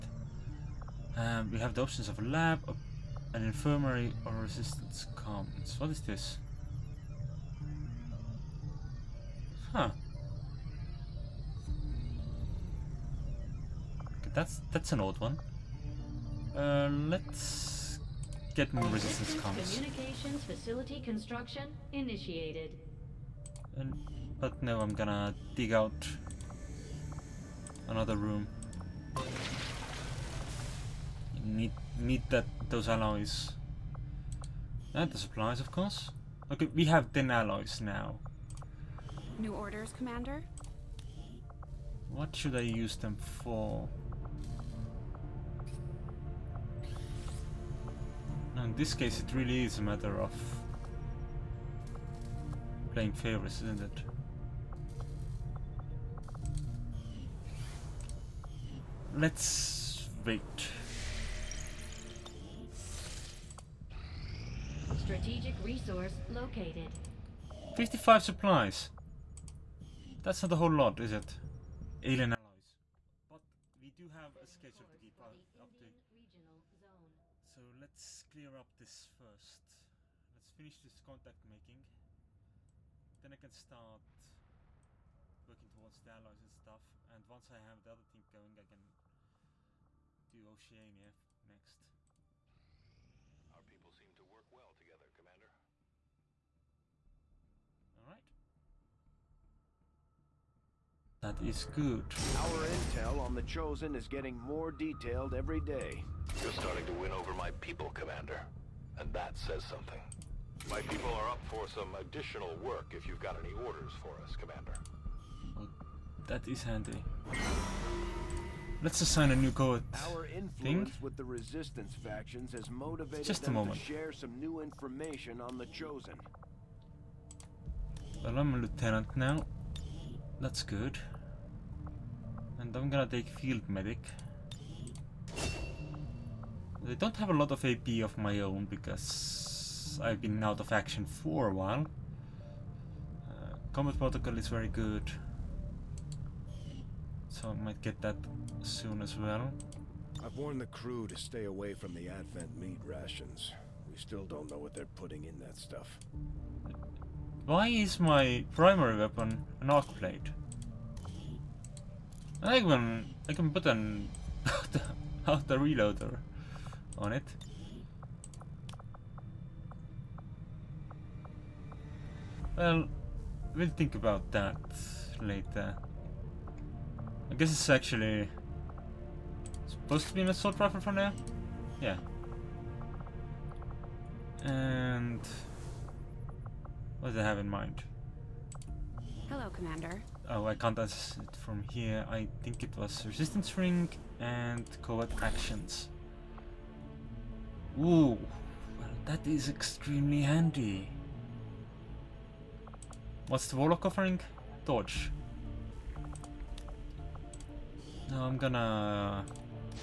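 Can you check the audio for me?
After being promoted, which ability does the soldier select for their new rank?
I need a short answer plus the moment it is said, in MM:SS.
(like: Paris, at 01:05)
Field medic, at 02:13.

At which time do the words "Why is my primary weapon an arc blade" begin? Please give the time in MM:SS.
02:37.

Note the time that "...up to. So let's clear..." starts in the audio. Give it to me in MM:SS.
01:15.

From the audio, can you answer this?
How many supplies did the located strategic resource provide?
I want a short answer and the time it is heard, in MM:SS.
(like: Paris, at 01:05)
55, at 01:07.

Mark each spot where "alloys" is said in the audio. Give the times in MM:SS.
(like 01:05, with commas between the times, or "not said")
00:32, 00:37, 01:12.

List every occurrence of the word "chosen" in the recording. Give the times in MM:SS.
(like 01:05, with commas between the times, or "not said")
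01:43, 02:05.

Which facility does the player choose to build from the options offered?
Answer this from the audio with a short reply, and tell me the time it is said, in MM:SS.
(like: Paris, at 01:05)
Resistance comms, at 00:18.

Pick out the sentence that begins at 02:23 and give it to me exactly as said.
Uh, combat protocol is very good.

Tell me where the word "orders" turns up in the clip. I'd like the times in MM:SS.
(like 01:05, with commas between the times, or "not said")
00:39, 01:53.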